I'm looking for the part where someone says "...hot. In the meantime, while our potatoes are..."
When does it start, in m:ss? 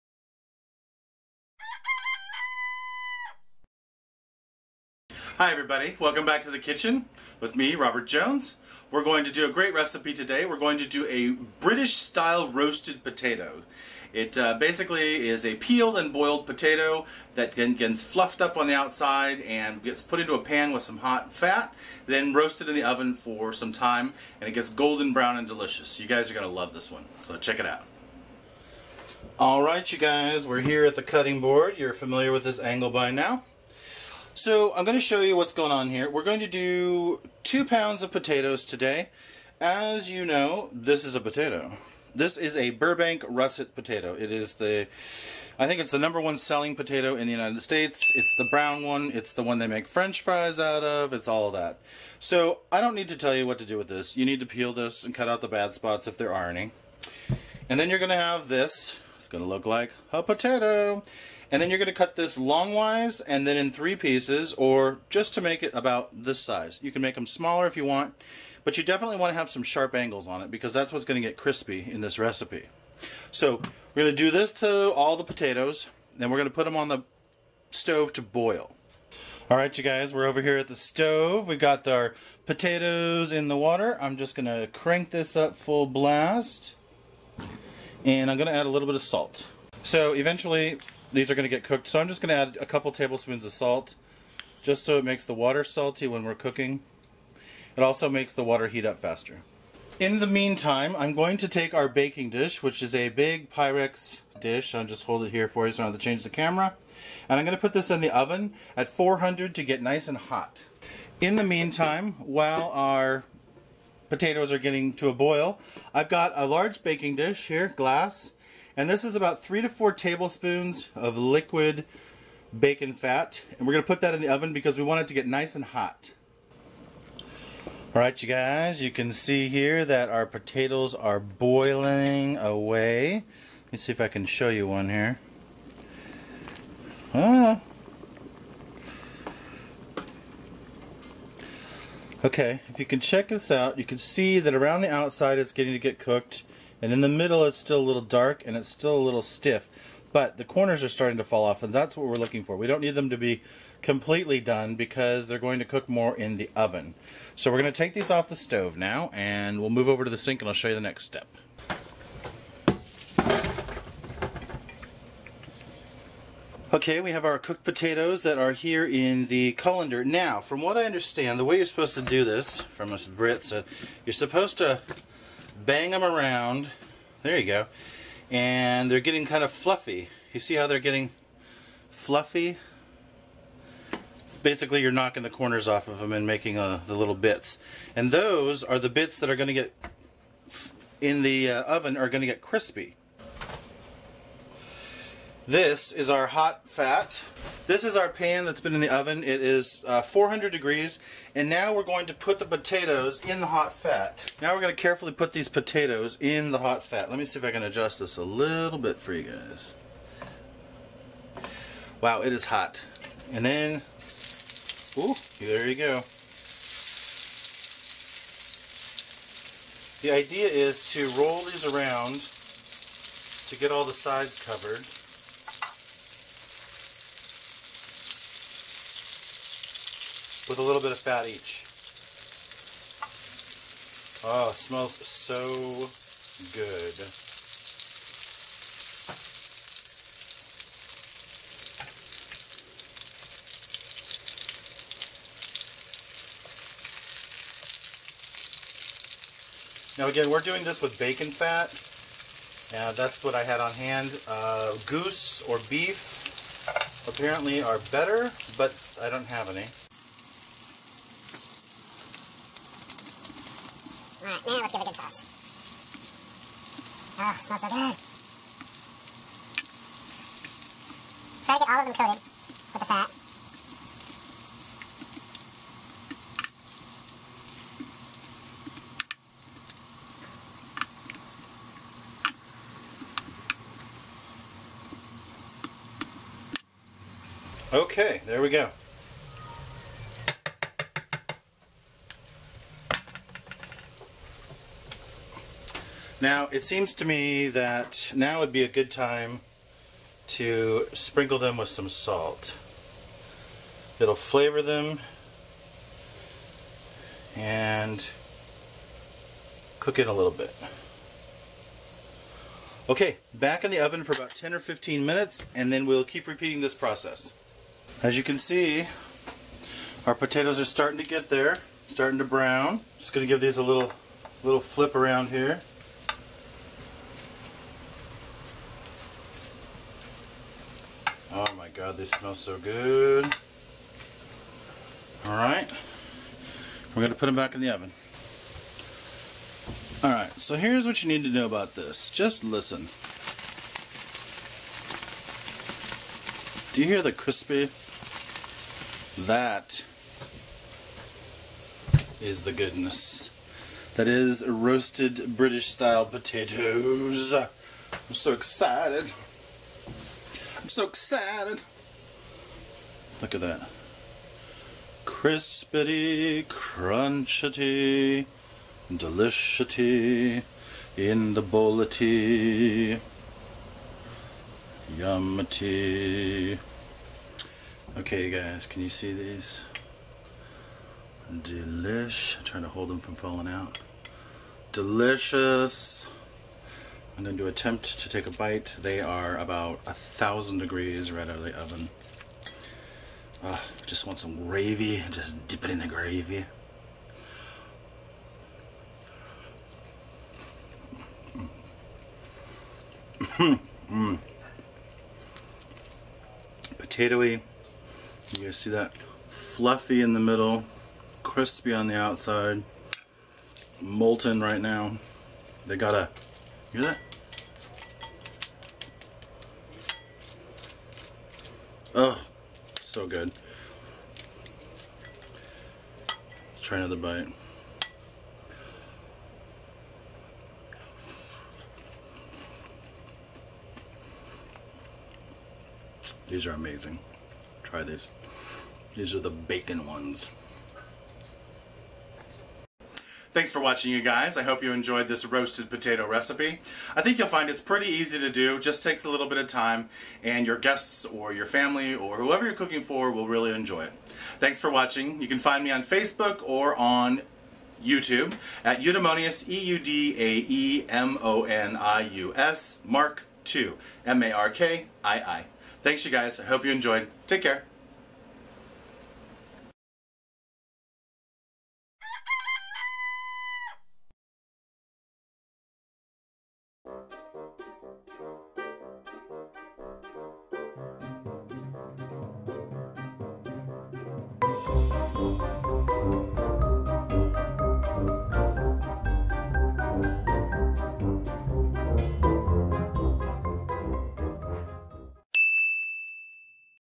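1:50.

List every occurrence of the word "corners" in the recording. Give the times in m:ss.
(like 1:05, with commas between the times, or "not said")
2:30, 3:05.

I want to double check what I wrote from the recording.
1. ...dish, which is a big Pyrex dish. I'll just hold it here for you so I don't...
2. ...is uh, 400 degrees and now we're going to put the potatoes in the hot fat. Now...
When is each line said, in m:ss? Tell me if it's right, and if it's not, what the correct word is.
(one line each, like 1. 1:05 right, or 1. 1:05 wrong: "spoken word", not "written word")
1. 1:42 right
2. 3:19 right.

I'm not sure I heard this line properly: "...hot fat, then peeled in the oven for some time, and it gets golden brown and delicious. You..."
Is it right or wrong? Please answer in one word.
wrong.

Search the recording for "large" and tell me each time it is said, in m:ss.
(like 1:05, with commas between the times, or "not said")
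1:56.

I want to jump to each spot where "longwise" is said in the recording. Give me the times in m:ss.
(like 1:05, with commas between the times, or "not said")
1:02.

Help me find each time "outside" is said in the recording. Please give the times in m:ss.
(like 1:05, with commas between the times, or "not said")
0:18, 2:24, 6:51.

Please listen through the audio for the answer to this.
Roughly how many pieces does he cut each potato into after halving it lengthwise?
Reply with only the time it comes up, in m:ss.
1:03.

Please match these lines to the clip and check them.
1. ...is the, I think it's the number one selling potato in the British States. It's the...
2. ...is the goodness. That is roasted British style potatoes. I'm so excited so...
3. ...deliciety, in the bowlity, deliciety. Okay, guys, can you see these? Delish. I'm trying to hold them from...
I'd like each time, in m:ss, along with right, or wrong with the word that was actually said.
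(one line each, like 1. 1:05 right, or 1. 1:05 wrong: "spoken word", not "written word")
1. 0:44 wrong: "United", not "British"
2. 5:52 right
3. 6:08 wrong: "yummity", not "deliciety".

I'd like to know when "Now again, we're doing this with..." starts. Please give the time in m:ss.
4:09.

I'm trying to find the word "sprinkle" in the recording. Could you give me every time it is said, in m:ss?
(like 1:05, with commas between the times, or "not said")
5:00.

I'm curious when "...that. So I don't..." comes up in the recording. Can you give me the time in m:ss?
0:51.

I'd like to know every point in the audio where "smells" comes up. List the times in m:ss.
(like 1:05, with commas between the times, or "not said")
3:54, 4:27, 5:32.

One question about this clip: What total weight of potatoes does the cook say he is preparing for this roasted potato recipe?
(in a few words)
2 pounds.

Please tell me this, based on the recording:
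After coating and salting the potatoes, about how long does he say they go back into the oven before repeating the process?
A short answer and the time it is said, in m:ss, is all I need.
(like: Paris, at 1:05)
10 or 15 minutes, at 5:14.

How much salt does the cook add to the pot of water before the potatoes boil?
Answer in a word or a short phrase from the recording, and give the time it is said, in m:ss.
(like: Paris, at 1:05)
A couple tablespoons, at 1:32.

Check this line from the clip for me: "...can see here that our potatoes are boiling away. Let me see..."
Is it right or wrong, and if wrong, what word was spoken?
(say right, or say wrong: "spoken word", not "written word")
right.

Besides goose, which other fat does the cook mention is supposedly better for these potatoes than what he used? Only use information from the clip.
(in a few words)
Beef.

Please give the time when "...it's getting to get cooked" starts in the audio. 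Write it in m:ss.
2:25.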